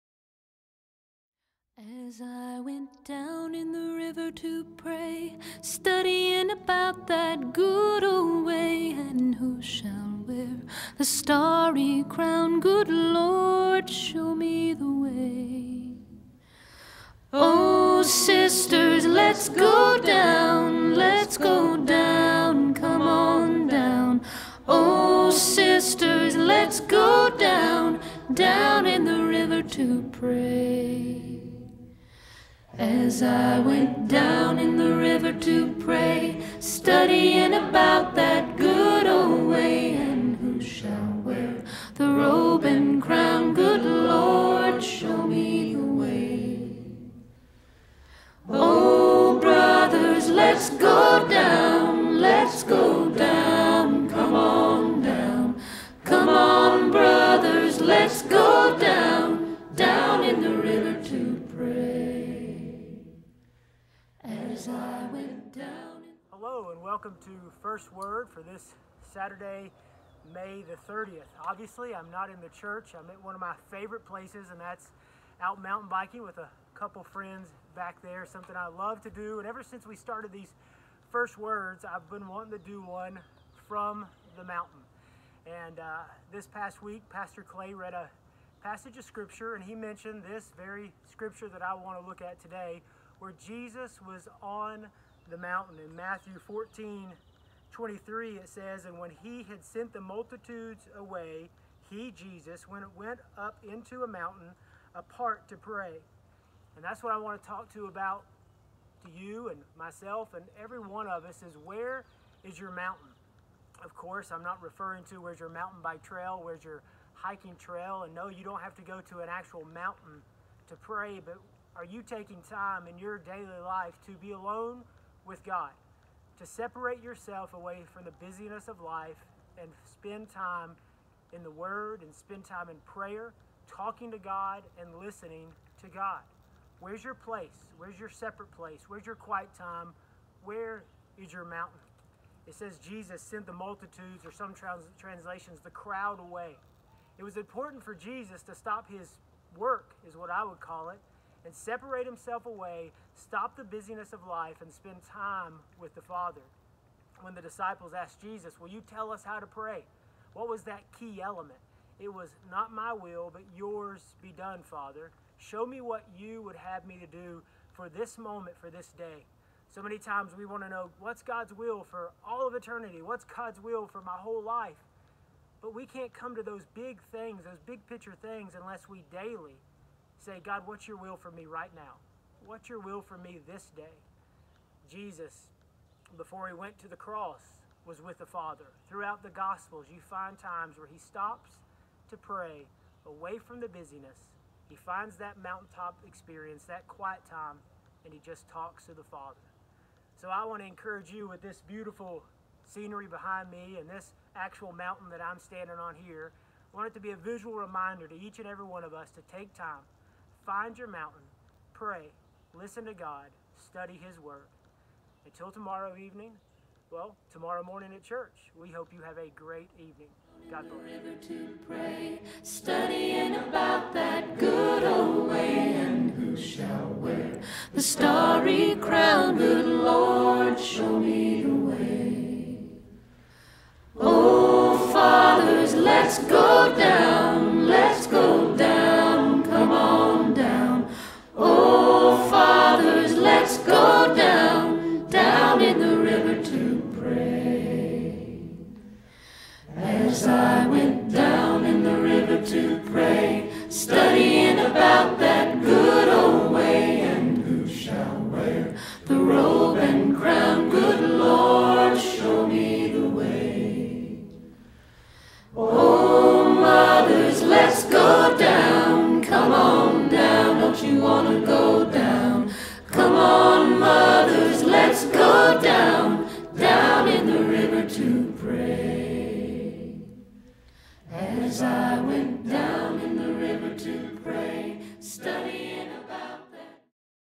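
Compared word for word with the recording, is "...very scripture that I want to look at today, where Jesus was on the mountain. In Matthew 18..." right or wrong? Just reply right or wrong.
wrong.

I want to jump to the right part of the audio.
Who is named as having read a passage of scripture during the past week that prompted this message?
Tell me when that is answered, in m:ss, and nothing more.
1:27.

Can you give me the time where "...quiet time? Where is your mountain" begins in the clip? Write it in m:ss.
2:19.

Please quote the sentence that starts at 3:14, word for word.
He finds that mountaintop experience, that quiet time, and he just talks to the Father.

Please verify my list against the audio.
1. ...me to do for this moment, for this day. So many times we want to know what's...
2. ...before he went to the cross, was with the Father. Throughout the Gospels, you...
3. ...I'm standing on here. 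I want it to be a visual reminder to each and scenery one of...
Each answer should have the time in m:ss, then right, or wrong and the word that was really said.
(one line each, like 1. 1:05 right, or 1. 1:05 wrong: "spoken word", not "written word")
1. 2:46 right
2. 3:06 right
3. 3:25 wrong: "every", not "scenery".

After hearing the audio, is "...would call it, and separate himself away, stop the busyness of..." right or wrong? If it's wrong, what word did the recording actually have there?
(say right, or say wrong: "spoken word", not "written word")
right.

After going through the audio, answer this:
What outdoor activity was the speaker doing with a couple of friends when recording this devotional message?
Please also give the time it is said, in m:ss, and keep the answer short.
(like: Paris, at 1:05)
Mountain biking, at 1:15.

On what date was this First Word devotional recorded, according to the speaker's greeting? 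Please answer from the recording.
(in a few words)
Saturday, May 30.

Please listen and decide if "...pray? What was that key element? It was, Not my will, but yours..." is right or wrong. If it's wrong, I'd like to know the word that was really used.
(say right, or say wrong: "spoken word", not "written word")
right.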